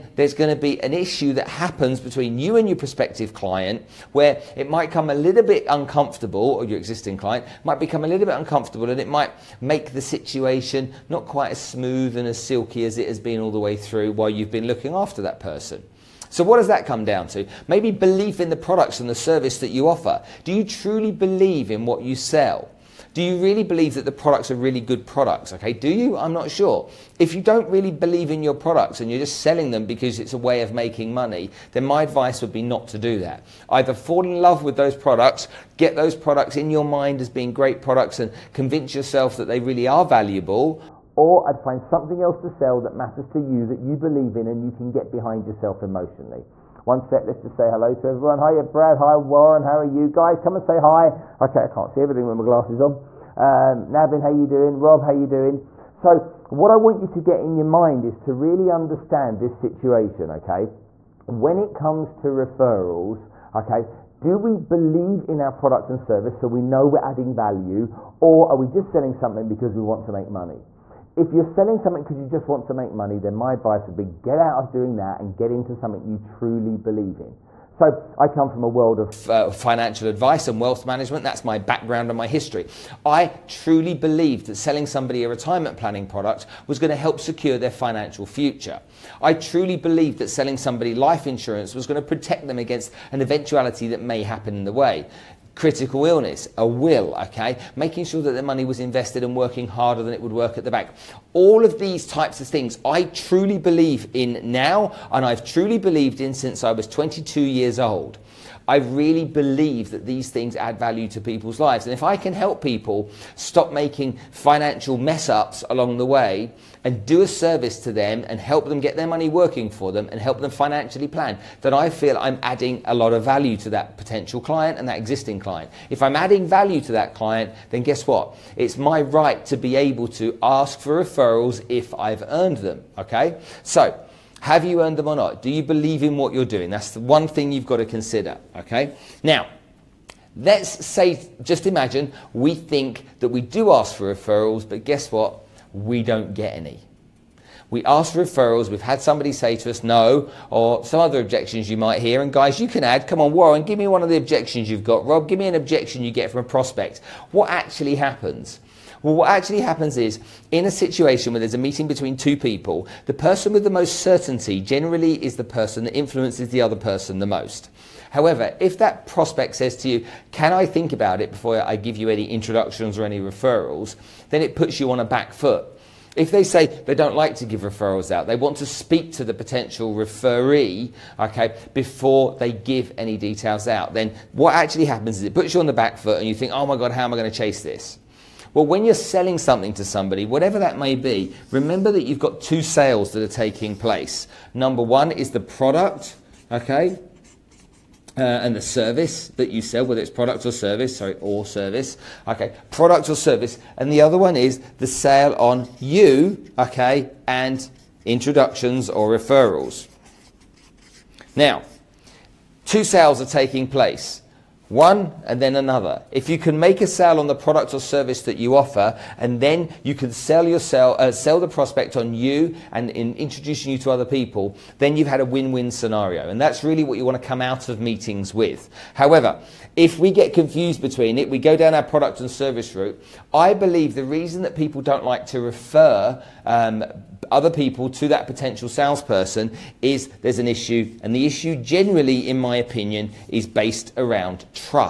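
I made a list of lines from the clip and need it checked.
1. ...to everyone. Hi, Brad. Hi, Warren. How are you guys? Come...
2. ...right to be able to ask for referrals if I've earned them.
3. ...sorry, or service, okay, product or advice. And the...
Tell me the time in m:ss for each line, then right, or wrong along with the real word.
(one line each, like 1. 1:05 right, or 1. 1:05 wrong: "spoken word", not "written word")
1. 0:47 right
2. 2:09 right
3. 3:20 wrong: "service", not "advice".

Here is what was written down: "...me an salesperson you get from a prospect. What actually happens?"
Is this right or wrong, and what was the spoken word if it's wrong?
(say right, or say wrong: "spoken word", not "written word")
wrong: "objection", not "salesperson".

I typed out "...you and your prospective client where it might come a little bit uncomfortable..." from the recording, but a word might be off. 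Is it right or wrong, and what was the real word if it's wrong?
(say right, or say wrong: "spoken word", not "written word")
right.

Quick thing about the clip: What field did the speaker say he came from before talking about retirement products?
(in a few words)
Financial advice and wealth management.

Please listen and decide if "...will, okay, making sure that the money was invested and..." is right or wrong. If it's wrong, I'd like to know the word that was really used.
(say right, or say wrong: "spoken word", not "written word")
right.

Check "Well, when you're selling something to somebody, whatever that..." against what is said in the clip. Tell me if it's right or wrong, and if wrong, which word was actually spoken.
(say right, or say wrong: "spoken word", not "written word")
right.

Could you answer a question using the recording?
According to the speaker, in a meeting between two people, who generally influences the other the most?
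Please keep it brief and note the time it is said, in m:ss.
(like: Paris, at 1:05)
The person with the most certainty, at 2:43.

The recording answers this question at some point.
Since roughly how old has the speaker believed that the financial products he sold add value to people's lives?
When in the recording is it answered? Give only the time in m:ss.
1:46.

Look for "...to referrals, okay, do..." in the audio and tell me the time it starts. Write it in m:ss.
1:02.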